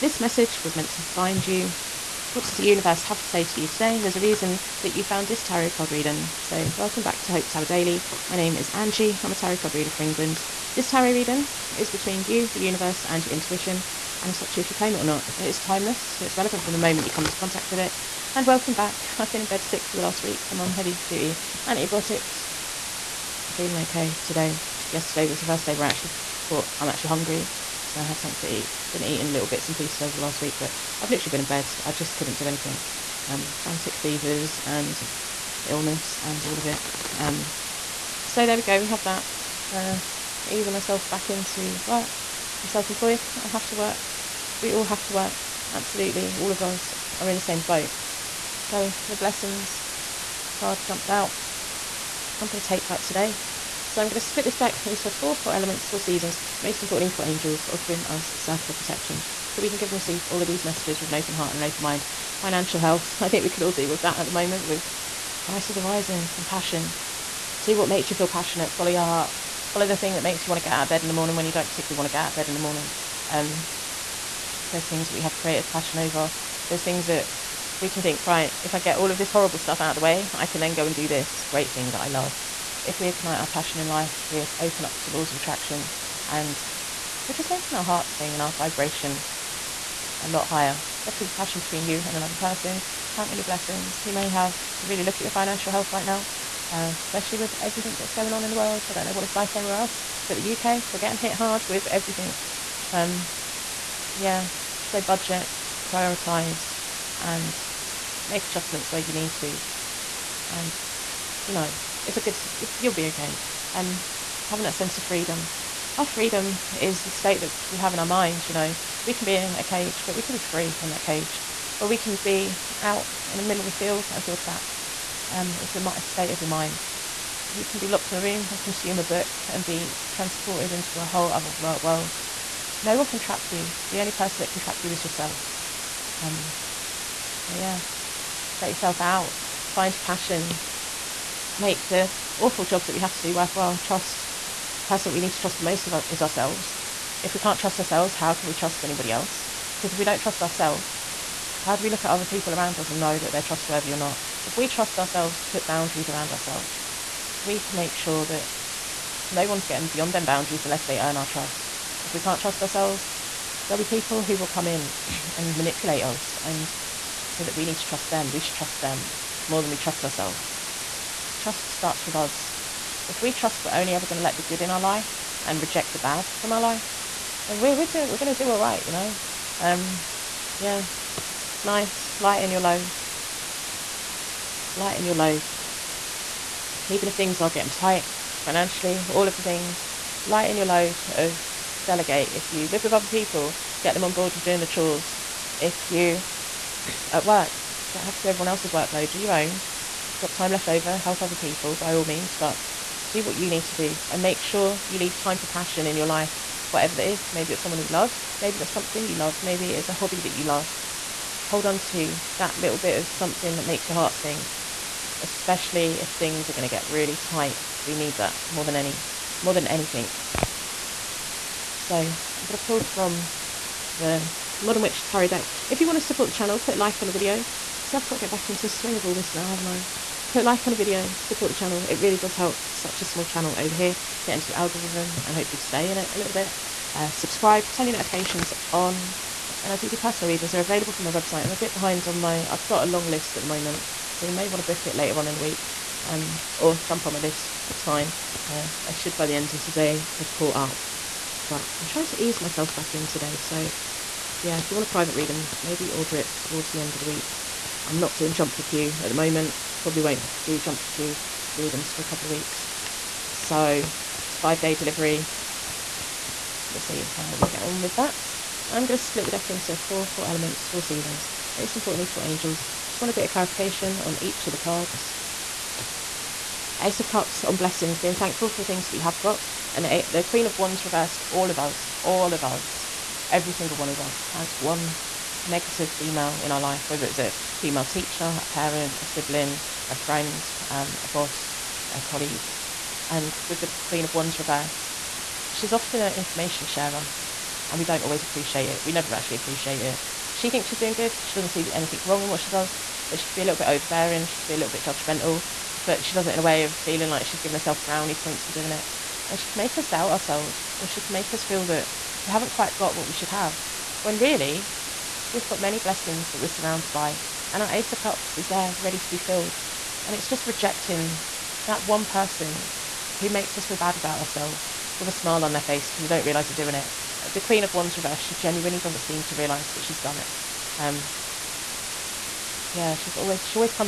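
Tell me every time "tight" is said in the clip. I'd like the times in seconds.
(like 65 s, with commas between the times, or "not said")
187 s, 217 s.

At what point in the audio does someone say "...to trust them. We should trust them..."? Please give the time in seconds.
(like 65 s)
167 s.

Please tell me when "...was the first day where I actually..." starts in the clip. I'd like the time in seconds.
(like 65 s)
25 s.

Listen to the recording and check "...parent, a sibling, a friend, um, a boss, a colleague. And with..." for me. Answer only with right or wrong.
right.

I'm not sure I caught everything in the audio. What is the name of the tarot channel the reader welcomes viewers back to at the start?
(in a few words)
Hope Tarot Daily.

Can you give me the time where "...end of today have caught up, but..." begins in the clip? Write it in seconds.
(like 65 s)
249 s.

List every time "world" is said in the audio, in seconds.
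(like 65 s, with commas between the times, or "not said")
98 s, 131 s.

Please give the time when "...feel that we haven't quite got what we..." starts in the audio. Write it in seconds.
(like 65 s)
311 s.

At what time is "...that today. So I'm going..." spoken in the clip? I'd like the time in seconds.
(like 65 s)
52 s.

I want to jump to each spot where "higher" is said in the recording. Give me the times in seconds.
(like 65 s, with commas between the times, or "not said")
90 s.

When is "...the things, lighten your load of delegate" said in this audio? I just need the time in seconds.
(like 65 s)
189 s.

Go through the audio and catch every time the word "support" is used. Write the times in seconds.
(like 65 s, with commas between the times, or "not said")
225 s, 231 s.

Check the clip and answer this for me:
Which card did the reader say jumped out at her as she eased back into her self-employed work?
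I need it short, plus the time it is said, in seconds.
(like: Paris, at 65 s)
The blessings card, at 49 s.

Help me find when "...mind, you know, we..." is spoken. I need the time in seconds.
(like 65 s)
118 s.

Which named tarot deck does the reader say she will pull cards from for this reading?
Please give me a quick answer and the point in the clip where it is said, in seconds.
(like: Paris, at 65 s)
Modern Witch Tarot, at 224 s.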